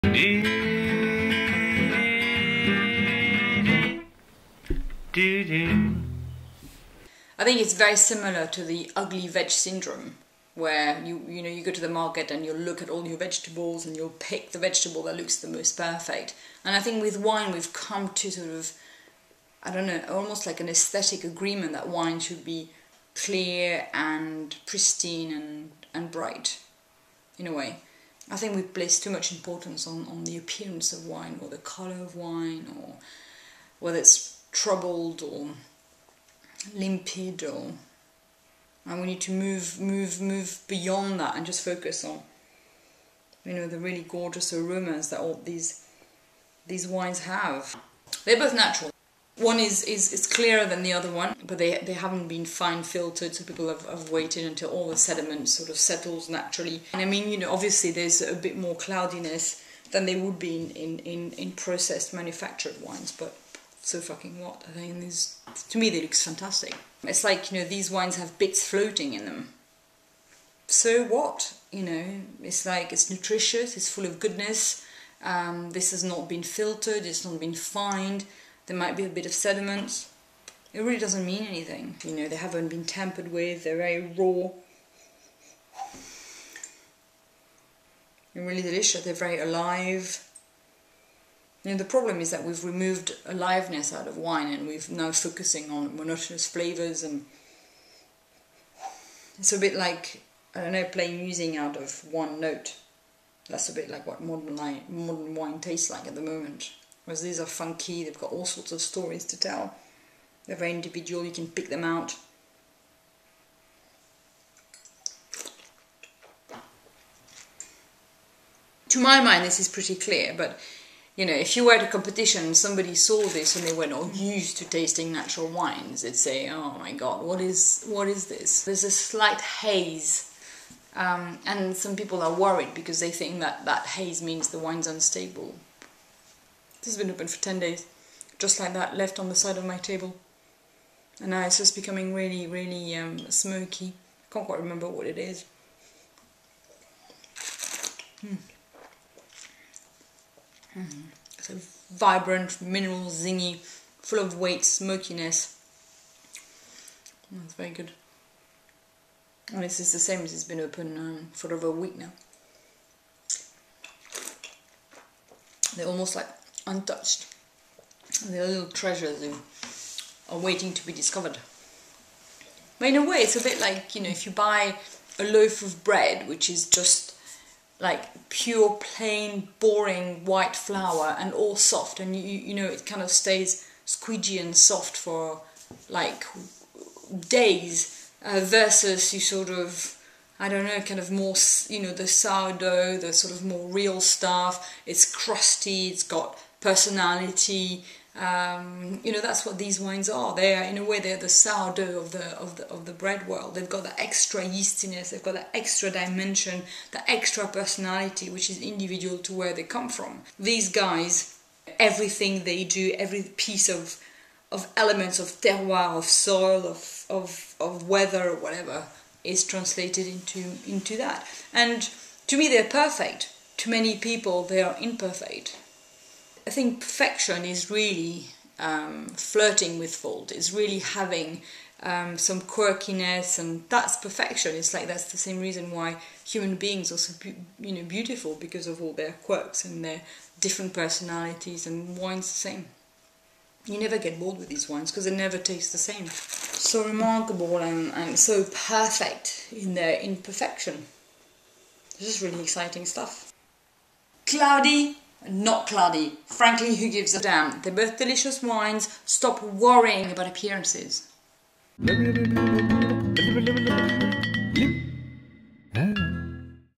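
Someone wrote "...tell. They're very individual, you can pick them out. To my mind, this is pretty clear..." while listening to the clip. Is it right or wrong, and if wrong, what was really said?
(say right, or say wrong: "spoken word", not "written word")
right.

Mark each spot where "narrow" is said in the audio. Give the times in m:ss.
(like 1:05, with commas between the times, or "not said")
not said.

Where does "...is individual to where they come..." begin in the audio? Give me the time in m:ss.
3:28.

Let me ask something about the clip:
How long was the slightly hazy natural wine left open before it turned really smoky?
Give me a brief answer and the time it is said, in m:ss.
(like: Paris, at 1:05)
10 days, at 2:17.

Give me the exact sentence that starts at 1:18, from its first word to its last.
There might be a bit of sediment.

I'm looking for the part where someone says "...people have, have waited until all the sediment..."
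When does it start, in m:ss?
0:53.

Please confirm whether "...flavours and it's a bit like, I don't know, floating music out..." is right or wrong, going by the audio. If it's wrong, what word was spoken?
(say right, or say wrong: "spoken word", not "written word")
wrong: "playing", not "floating".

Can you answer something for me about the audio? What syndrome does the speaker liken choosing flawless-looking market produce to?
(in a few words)
ugly veg syndrome.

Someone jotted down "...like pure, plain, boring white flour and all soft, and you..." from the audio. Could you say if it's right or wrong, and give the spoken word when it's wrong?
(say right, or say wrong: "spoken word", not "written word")
right.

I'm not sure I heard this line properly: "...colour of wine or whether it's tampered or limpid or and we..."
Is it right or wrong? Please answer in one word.
wrong.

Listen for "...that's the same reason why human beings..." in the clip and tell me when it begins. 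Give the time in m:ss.
3:54.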